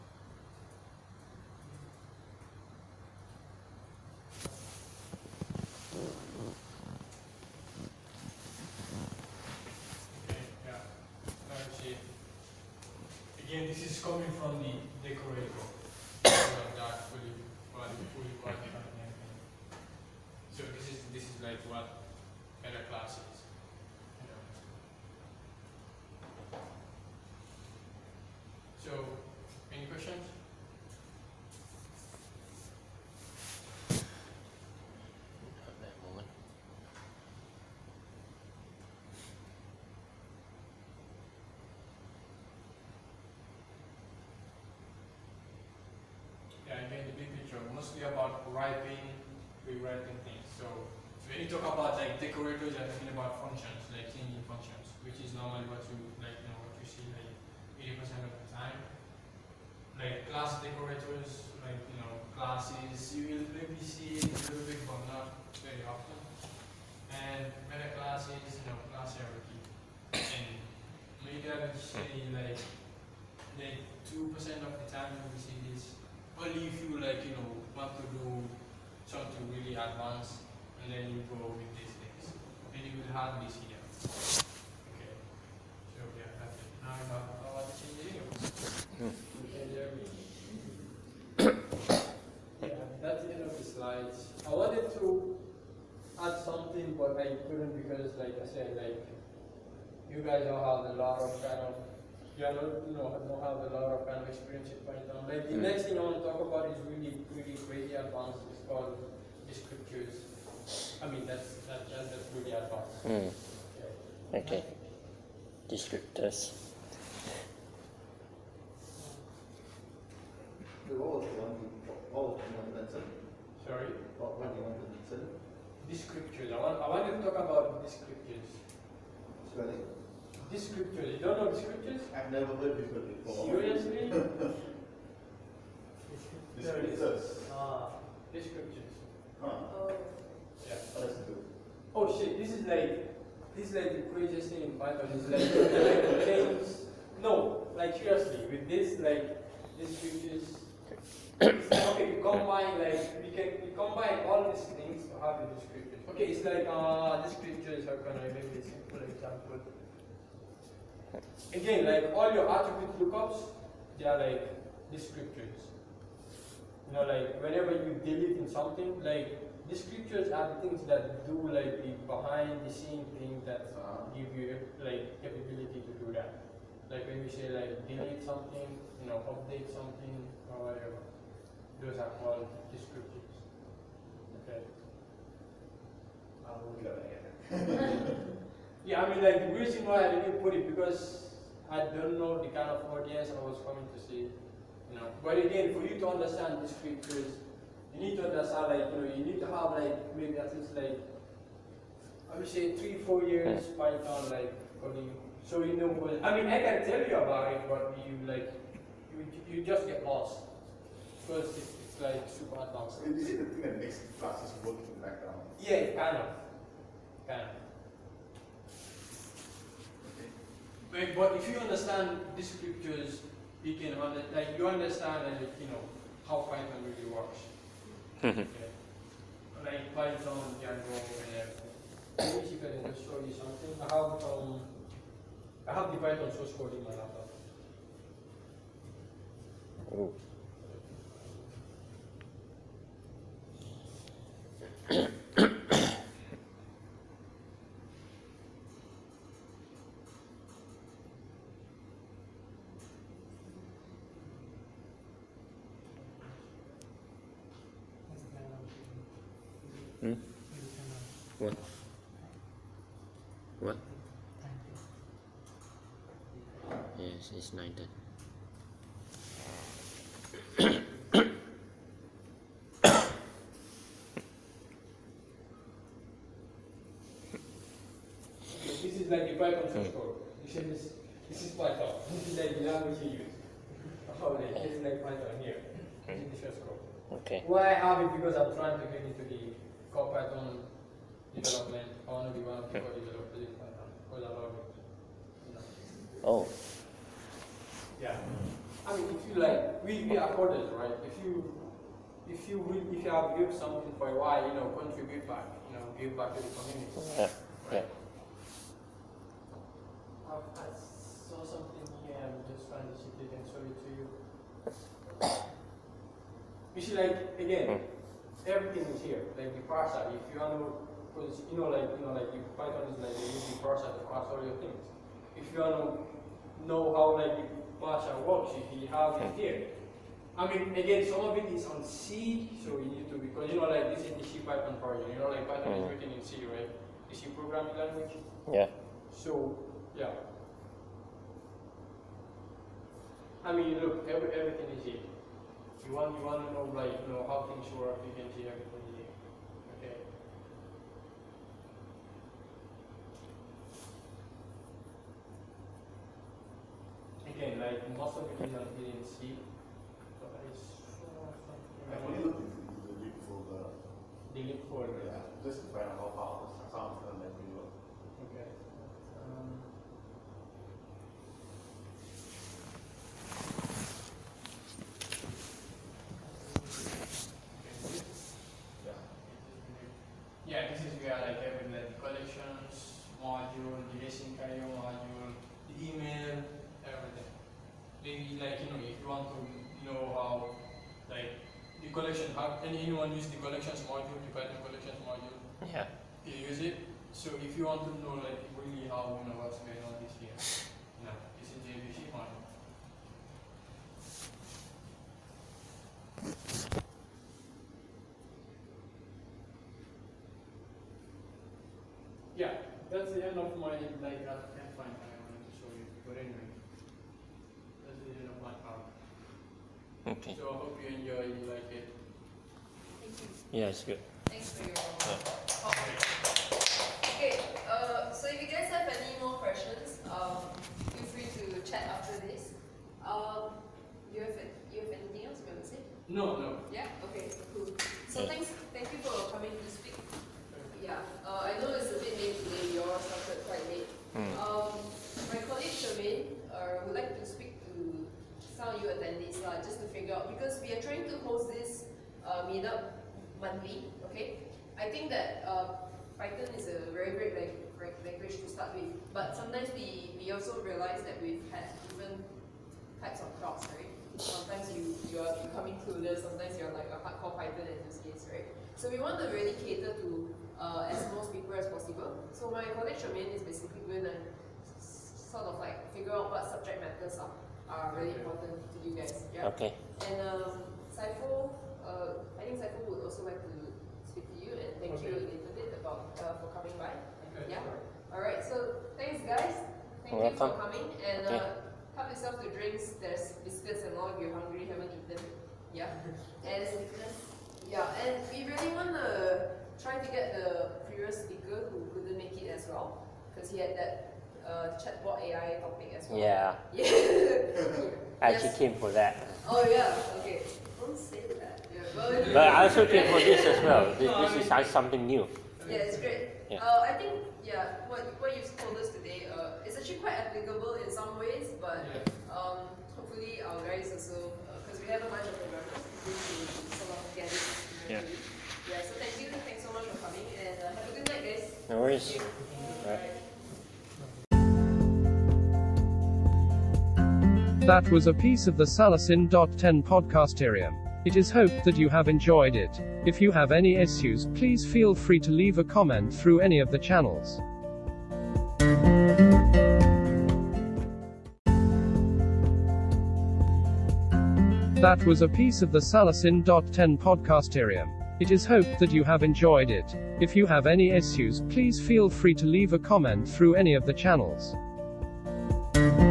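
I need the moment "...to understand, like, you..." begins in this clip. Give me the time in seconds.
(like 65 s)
198 s.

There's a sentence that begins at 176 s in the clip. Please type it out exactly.
Like when we say like delete something, you know, update something or whatever.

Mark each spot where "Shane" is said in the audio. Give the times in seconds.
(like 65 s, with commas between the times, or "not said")
not said.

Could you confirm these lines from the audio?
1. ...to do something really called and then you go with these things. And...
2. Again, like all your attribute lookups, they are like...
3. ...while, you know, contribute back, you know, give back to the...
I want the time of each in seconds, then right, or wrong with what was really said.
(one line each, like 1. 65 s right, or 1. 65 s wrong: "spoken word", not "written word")
1. 77 s wrong: "advanced", not "called"
2. 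161 s right
3. 304 s right.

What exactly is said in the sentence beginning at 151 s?
okay, we combine like we can we combine all these things to have the scriptures.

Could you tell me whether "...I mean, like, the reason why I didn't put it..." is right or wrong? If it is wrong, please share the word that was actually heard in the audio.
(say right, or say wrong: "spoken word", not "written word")
right.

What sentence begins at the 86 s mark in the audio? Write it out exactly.
Now you have power to change the no.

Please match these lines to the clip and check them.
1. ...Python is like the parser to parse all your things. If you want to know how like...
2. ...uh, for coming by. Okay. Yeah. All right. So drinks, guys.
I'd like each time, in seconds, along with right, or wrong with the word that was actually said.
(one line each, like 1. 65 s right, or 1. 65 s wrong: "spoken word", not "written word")
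1. 322 s right
2. 486 s wrong: "thanks", not "drinks".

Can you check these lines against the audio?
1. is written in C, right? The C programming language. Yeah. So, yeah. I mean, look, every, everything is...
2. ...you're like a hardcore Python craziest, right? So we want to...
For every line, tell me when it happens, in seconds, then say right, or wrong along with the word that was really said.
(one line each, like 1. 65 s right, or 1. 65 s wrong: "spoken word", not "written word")
1. 335 s right
2. 466 s wrong: "enthusiast", not "craziest".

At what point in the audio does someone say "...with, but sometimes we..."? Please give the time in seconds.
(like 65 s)
458 s.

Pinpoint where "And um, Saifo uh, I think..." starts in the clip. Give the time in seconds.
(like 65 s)
480 s.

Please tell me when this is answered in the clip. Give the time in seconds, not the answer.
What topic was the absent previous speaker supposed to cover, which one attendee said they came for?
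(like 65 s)
504 s.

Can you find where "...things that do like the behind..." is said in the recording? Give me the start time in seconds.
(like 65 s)
170 s.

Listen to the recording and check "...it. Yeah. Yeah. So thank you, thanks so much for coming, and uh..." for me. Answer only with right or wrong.
right.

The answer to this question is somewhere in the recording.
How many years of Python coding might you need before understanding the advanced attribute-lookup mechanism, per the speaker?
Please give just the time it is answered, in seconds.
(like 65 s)
202 s.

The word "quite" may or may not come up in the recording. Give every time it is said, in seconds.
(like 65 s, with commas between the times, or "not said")
443 s, 520 s.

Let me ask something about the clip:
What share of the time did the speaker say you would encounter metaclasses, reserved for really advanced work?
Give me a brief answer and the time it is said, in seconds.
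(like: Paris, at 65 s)
2%, at 74 s.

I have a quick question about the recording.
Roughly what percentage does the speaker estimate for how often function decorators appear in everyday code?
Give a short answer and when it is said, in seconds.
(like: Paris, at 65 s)
80%, at 57 s.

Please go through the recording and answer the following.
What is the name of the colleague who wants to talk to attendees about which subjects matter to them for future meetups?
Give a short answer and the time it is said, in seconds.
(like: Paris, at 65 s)
Charmaine, at 445 s.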